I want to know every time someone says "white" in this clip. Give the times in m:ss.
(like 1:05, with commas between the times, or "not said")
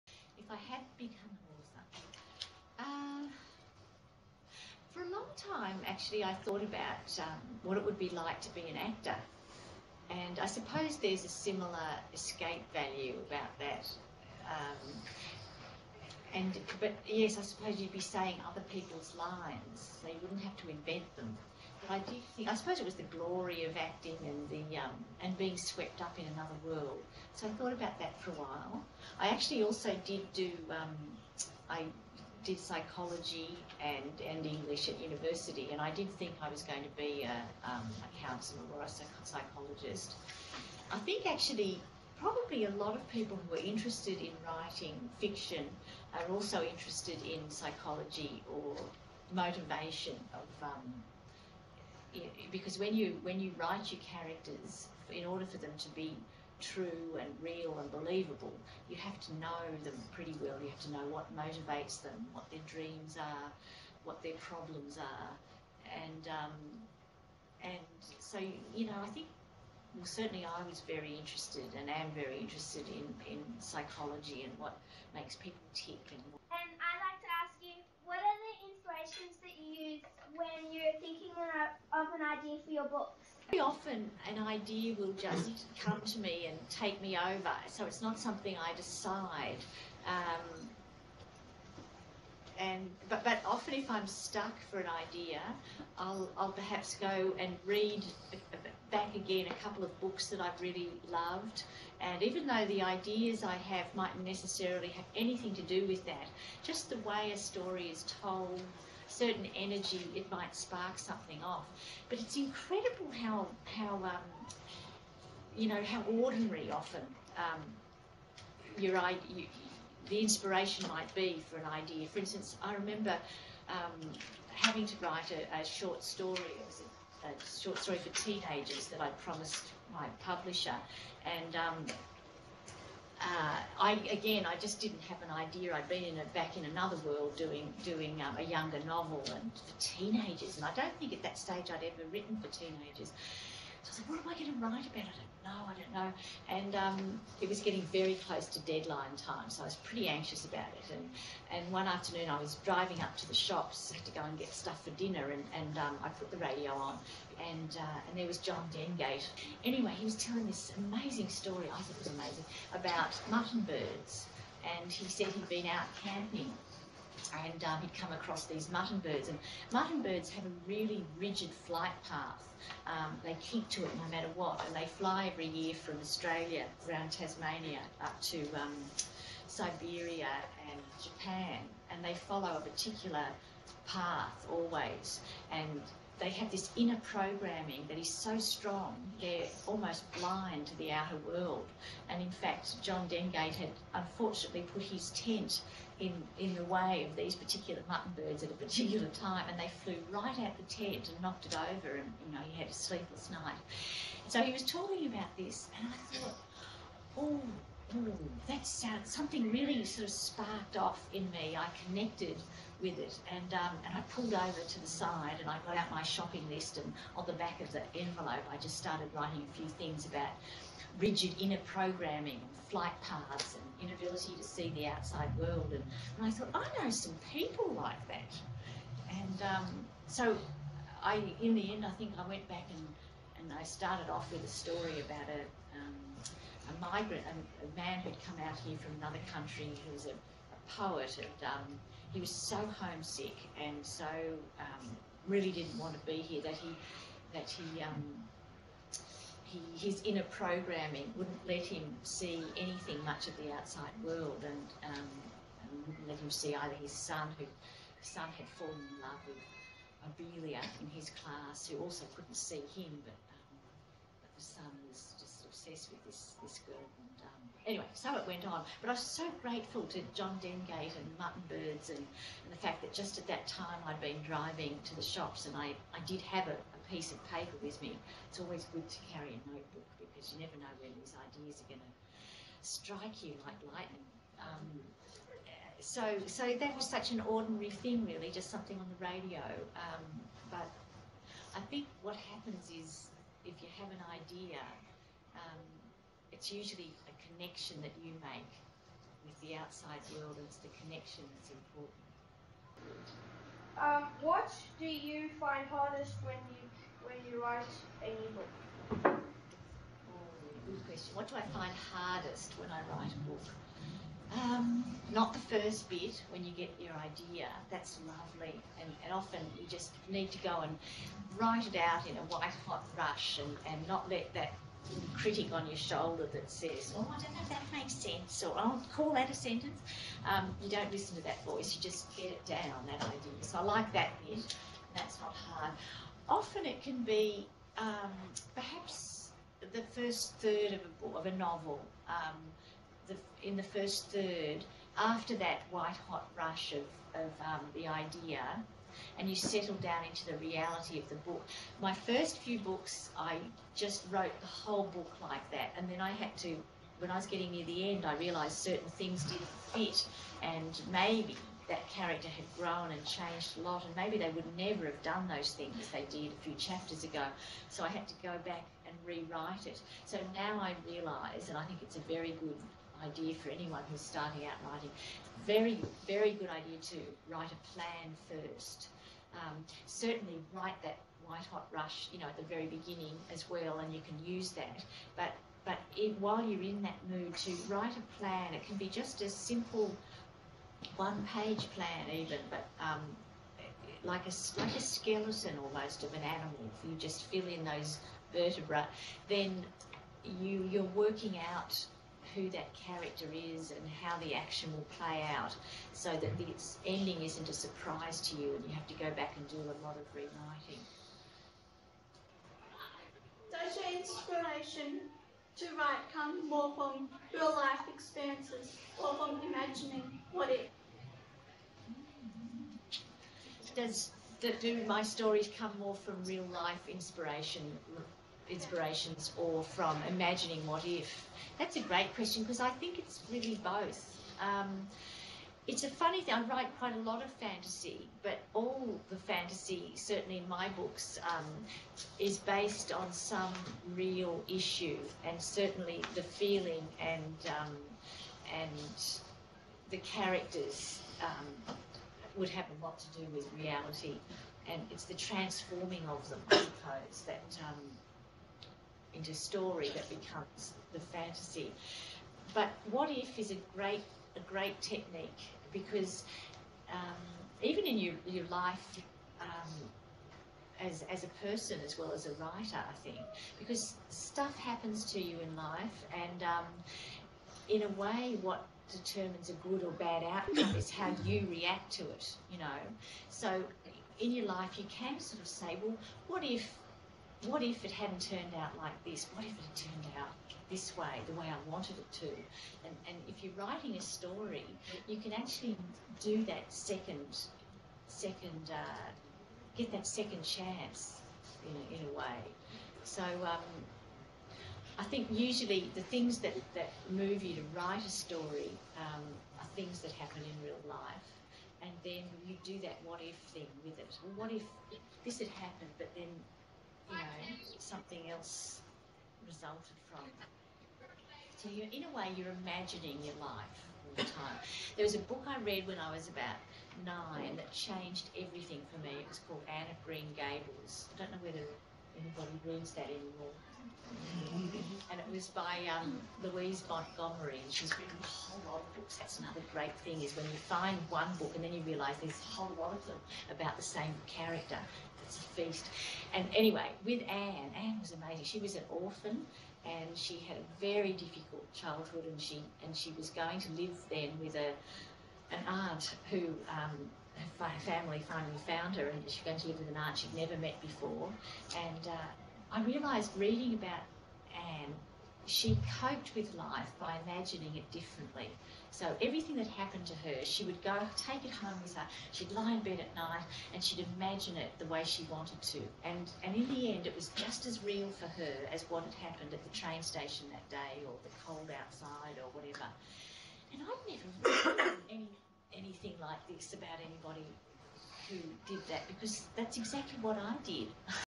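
5:22, 5:45, 6:21.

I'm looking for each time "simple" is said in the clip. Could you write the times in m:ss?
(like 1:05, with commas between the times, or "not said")
6:29.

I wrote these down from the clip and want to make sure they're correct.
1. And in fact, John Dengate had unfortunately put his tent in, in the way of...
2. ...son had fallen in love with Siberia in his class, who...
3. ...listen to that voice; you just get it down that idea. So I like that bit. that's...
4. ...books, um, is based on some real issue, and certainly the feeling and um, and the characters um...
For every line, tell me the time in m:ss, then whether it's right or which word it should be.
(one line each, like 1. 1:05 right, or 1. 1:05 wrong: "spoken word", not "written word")
1. 3:12 right
2. 4:18 wrong: "Abelia", not "Siberia"
3. 5:30 right
4. 7:20 right.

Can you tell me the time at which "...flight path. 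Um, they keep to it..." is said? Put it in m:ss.
2:51.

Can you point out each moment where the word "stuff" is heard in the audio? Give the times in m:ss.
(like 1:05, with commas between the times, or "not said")
2:34, 7:54.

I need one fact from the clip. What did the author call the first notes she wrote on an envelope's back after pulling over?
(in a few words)
Shopping list.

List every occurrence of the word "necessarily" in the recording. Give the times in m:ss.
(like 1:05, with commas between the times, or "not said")
1:44.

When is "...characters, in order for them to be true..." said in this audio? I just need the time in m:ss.
0:54.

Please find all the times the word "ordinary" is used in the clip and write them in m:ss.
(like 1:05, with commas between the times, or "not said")
1:56, 4:47.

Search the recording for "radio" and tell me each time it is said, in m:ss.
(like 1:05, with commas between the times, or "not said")
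2:36, 4:49.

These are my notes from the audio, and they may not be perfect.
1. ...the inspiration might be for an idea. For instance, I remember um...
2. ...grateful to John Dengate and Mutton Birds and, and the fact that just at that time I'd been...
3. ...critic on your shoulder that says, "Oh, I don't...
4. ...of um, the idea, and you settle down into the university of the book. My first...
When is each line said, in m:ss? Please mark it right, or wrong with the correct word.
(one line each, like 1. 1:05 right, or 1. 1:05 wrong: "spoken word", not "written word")
1. 2:00 right
2. 4:29 right
3. 5:25 right
4. 5:47 wrong: "reality", not "university".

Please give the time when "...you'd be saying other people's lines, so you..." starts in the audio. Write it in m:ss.
0:17.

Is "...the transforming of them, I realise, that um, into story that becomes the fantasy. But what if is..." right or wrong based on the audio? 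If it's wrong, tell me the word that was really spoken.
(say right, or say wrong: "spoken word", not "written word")
wrong: "suppose", not "realise".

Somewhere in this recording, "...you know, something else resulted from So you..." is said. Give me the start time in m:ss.
8:37.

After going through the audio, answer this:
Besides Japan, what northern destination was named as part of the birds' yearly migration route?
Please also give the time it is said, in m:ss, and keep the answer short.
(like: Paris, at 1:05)
Siberia, at 2:59.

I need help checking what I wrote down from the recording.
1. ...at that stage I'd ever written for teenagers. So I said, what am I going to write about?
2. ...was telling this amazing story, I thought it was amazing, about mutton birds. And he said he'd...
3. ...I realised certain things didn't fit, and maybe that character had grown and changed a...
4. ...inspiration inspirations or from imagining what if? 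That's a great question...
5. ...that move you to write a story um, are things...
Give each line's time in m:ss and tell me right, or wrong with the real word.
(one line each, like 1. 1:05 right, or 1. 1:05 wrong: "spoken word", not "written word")
1. 2:21 right
2. 2:40 right
3. 5:58 right
4. 7:06 right
5. 8:26 right.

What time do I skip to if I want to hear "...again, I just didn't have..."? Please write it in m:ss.
2:14.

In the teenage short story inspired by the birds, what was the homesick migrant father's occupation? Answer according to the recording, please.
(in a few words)
Poet.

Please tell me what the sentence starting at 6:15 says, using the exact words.
Very, very good idea to write a plan first.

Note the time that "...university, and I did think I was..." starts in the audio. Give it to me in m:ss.
0:35.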